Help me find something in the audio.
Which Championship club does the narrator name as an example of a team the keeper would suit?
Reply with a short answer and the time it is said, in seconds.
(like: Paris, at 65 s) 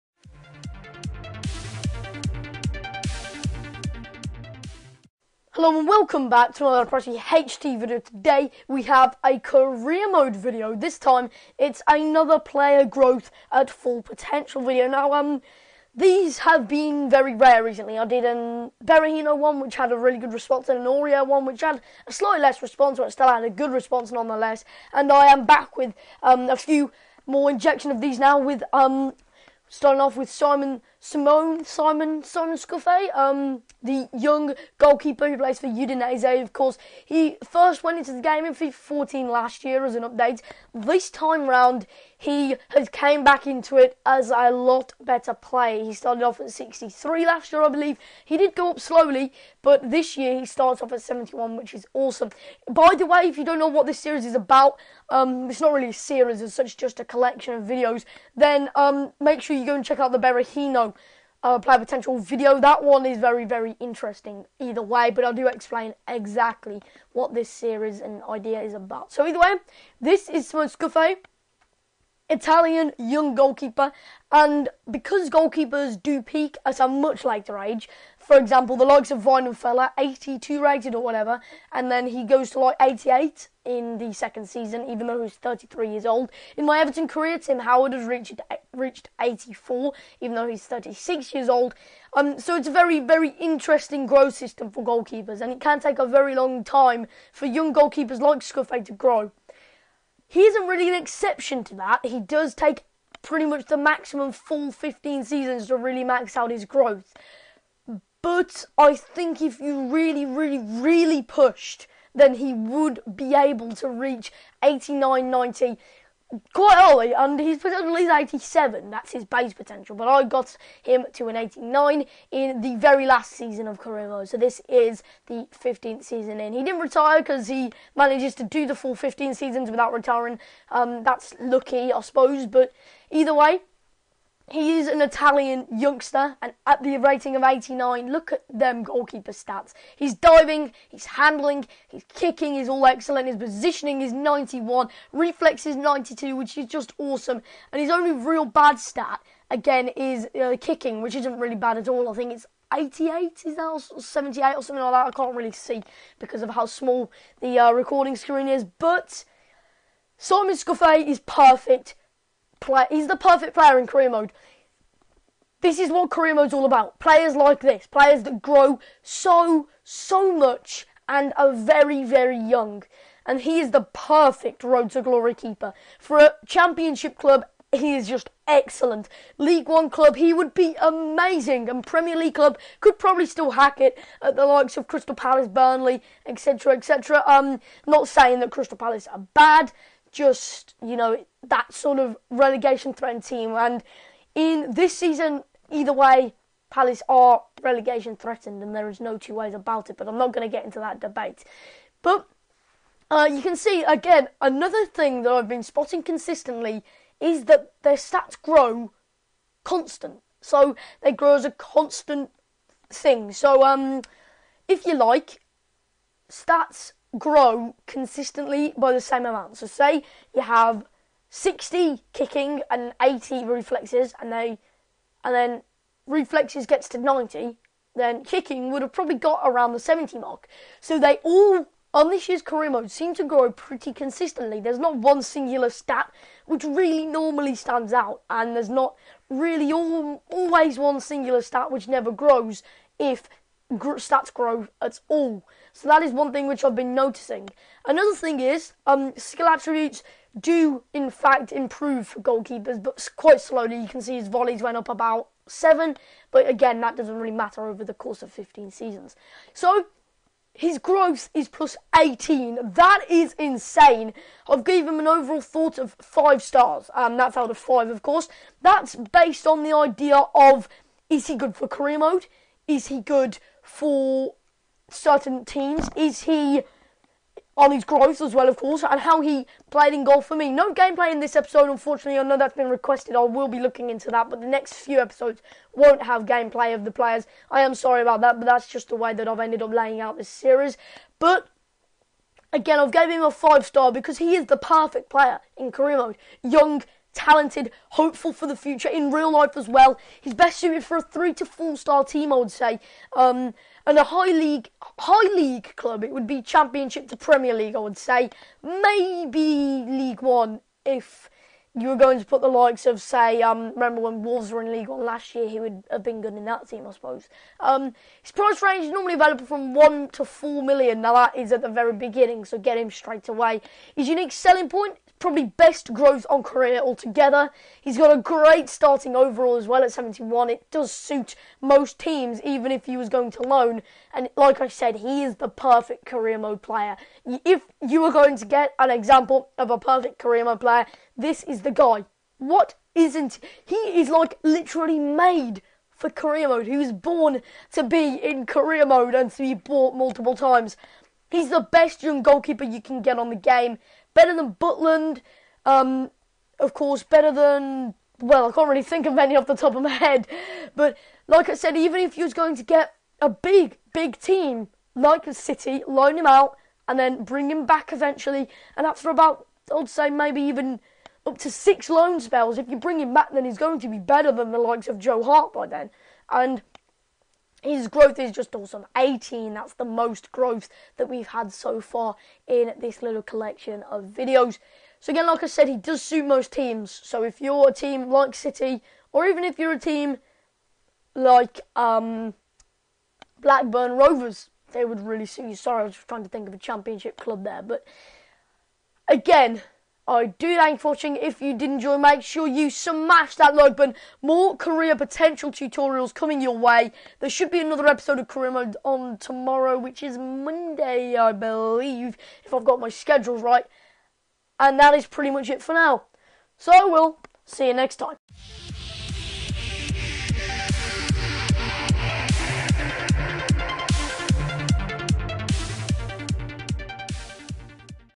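Blackburn Rovers, at 393 s.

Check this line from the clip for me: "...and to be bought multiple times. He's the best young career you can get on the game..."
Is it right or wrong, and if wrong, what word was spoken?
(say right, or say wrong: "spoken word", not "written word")
wrong: "goalkeeper", not "career".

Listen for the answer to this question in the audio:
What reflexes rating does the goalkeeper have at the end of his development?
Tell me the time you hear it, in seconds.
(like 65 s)
145 s.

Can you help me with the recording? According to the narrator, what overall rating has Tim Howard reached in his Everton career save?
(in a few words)
84.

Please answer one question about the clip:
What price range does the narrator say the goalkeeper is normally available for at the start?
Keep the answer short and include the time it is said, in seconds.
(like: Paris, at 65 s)
1 to 4 million, at 319 s.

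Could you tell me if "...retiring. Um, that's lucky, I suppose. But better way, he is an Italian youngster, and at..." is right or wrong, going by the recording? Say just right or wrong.
wrong.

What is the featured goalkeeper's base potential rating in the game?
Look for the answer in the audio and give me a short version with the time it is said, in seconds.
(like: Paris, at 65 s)
87, at 118 s.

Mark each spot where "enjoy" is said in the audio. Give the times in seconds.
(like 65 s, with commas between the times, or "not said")
401 s.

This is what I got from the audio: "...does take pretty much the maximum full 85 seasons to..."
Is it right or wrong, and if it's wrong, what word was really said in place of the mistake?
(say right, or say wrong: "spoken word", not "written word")
wrong: "15", not "85".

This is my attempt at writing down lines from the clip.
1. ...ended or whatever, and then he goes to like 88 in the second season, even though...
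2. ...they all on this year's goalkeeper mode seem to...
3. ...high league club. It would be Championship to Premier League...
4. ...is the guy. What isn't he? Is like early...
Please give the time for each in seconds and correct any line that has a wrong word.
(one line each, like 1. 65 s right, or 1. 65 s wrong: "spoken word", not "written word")
1. 80 s wrong: "rated", not "ended"
2. 230 s wrong: "career", not "goalkeeper"
3. 304 s right
4. 341 s wrong: "literally", not "early".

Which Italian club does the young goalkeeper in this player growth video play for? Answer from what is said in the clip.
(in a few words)
Udinese.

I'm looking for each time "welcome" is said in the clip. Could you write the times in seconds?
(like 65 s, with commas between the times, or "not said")
5 s.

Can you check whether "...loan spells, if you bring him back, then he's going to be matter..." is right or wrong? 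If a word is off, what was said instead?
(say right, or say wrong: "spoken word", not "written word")
wrong: "better", not "matter".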